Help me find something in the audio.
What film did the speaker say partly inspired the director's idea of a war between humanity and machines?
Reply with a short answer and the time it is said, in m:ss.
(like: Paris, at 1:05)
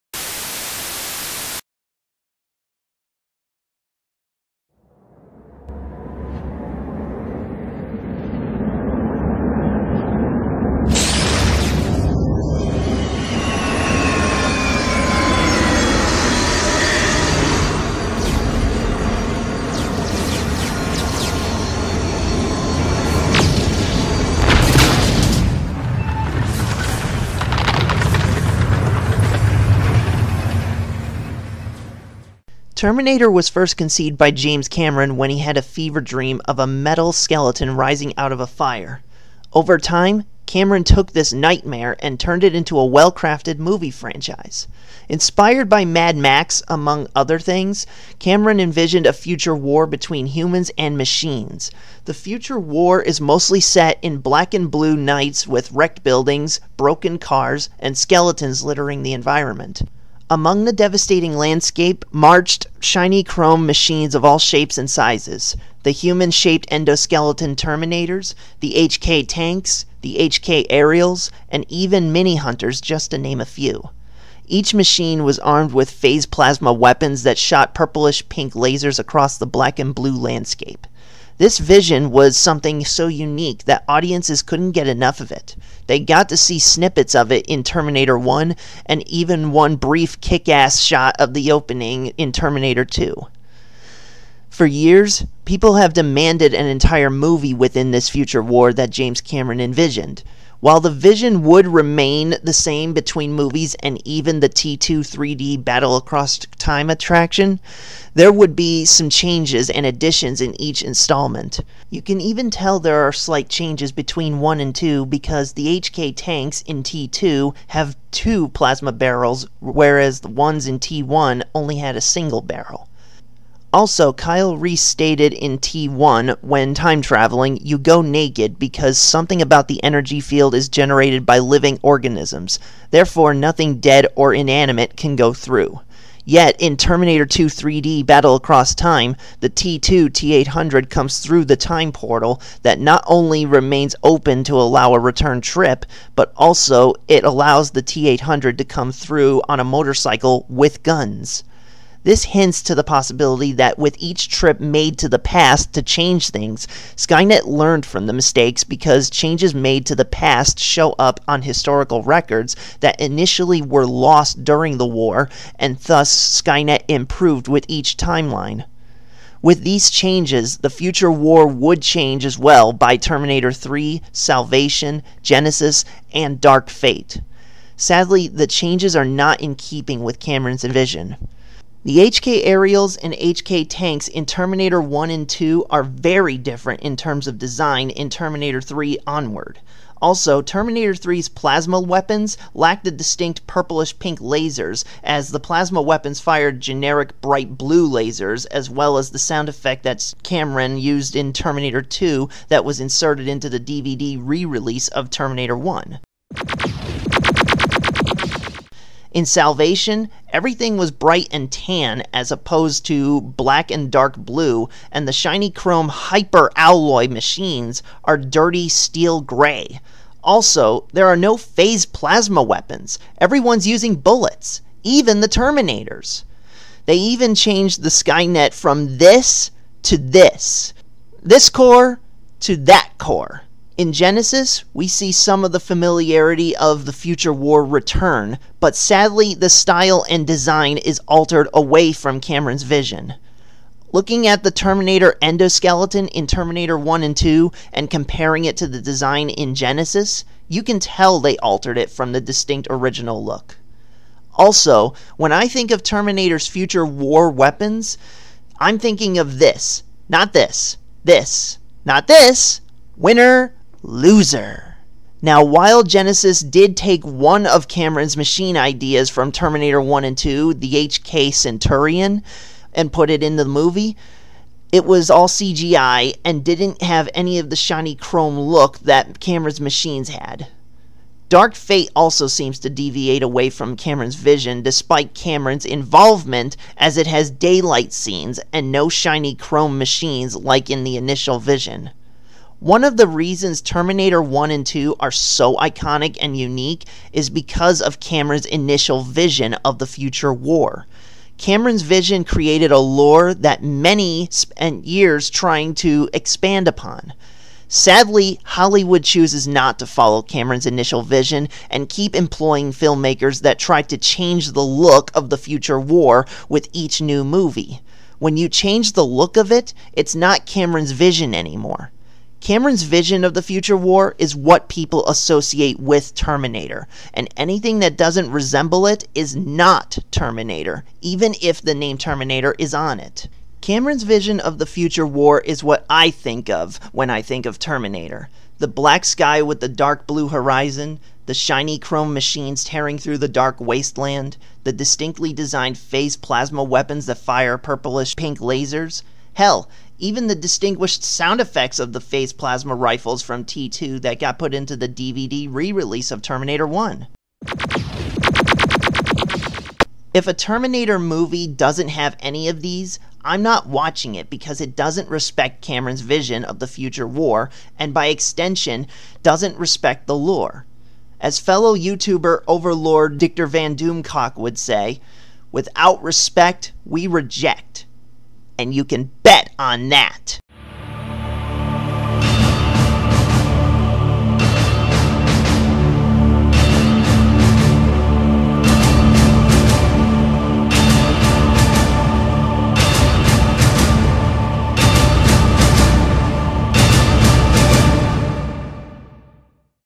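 Mad Max, at 0:45.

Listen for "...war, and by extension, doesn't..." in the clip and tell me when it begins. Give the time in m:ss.
6:07.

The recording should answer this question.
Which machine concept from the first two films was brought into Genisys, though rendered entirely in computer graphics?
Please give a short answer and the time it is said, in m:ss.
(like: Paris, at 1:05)
HK Centurion, at 4:30.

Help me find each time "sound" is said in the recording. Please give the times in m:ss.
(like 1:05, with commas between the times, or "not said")
3:19, 5:51.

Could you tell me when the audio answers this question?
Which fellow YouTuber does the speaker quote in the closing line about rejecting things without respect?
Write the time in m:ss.
6:13.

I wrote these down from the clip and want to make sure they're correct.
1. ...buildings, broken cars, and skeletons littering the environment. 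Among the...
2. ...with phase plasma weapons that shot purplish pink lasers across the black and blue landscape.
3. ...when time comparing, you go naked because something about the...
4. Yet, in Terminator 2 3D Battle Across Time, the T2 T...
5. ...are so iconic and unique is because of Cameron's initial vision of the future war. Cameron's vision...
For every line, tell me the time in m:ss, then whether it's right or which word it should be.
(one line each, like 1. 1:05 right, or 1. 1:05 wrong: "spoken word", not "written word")
1. 0:56 right
2. 1:15 right
3. 2:06 wrong: "traveling", not "comparing"
4. 2:16 right
5. 4:54 right.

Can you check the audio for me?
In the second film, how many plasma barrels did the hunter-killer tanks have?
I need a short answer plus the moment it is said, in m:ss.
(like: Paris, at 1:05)
2, at 1:58.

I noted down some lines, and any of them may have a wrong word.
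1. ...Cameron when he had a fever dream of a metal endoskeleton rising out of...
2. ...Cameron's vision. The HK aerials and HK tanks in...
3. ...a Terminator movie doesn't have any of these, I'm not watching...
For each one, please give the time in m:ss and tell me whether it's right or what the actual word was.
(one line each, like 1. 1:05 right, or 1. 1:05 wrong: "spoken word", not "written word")
1. 0:34 wrong: "skeleton", not "endoskeleton"
2. 3:00 right
3. 6:00 right.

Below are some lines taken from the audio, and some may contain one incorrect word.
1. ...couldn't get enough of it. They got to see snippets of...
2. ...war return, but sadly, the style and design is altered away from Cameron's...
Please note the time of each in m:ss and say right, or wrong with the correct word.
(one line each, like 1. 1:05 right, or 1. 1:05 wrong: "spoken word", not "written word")
1. 1:24 right
2. 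3:57 right.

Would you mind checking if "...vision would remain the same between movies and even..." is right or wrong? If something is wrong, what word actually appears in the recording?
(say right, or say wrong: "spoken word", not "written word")
right.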